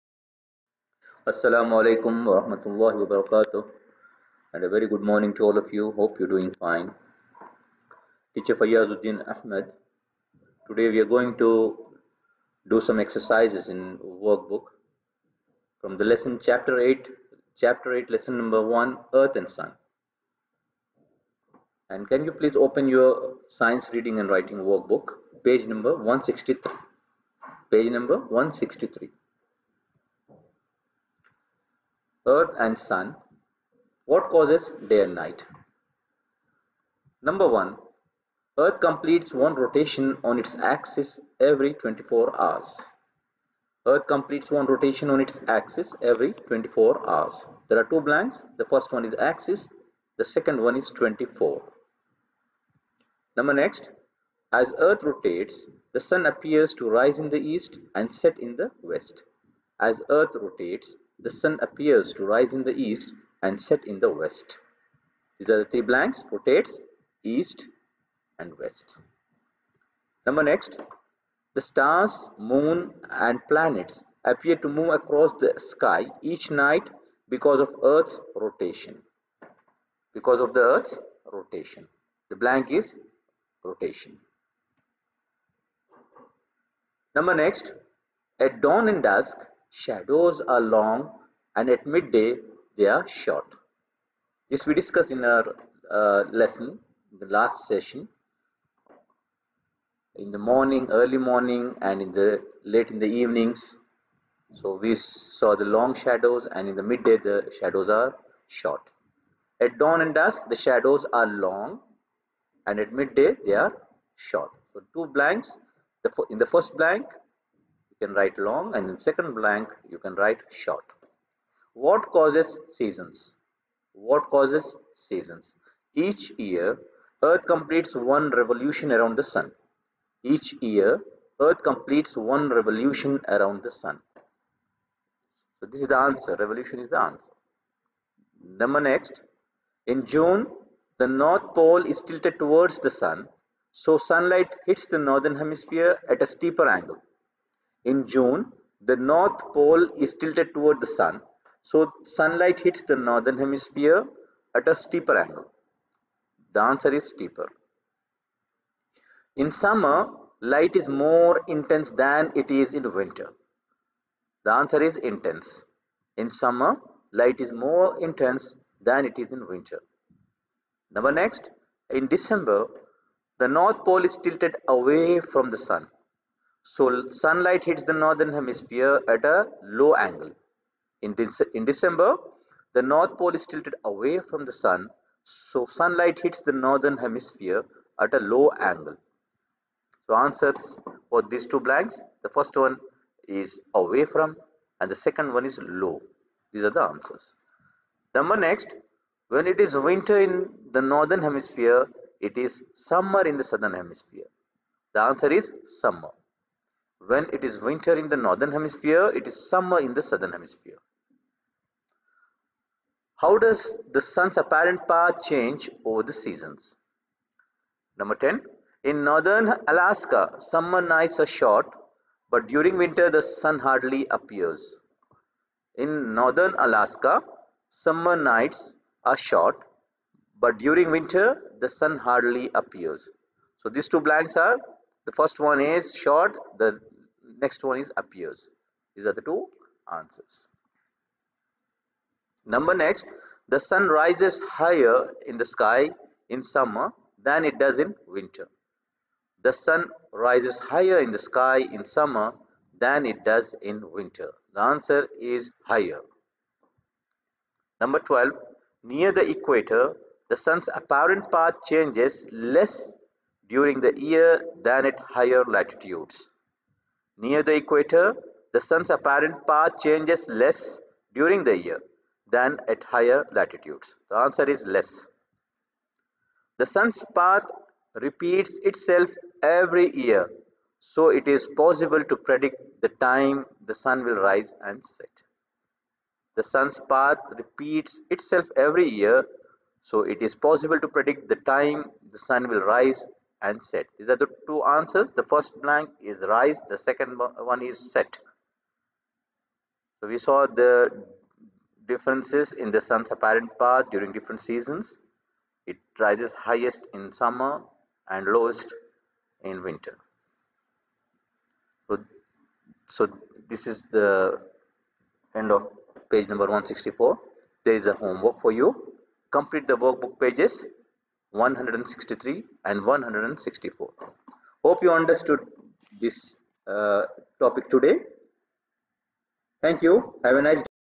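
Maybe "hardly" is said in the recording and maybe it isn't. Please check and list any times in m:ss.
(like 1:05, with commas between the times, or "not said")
3:43, 3:51.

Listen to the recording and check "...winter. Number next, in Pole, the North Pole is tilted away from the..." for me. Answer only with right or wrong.
wrong.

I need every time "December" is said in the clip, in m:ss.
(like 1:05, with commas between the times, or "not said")
2:52, 3:01.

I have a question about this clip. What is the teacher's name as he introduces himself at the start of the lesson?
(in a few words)
Fayyazuddin Ahmed.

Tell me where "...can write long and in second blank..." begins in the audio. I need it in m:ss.
1:58.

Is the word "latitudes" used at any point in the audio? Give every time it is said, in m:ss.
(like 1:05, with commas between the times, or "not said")
4:25, 4:33.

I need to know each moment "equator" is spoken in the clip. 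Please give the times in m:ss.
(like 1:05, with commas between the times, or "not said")
4:19, 4:27.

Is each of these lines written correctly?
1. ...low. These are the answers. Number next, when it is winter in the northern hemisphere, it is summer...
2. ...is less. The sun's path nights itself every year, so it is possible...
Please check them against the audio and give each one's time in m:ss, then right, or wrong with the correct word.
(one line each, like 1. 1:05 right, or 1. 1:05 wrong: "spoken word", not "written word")
1. 3:15 right
2. 4:34 wrong: "repeats", not "nights".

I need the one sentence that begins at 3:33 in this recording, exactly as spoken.
How does the sun's apparent path change over the seasons?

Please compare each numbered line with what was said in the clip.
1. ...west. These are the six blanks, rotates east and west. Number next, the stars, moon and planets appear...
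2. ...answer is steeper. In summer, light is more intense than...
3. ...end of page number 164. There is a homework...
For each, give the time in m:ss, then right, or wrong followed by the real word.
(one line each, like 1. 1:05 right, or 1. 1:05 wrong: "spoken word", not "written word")
1. 1:04 wrong: "three", not "six"
2. 2:36 right
3. 5:15 right.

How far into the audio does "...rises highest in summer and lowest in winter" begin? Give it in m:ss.
5:05.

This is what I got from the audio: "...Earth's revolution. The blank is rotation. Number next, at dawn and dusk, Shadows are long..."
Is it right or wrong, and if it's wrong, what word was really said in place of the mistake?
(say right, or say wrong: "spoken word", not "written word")
wrong: "rotation", not "revolution".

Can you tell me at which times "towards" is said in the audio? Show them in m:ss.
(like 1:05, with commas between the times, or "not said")
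2:22, 2:30.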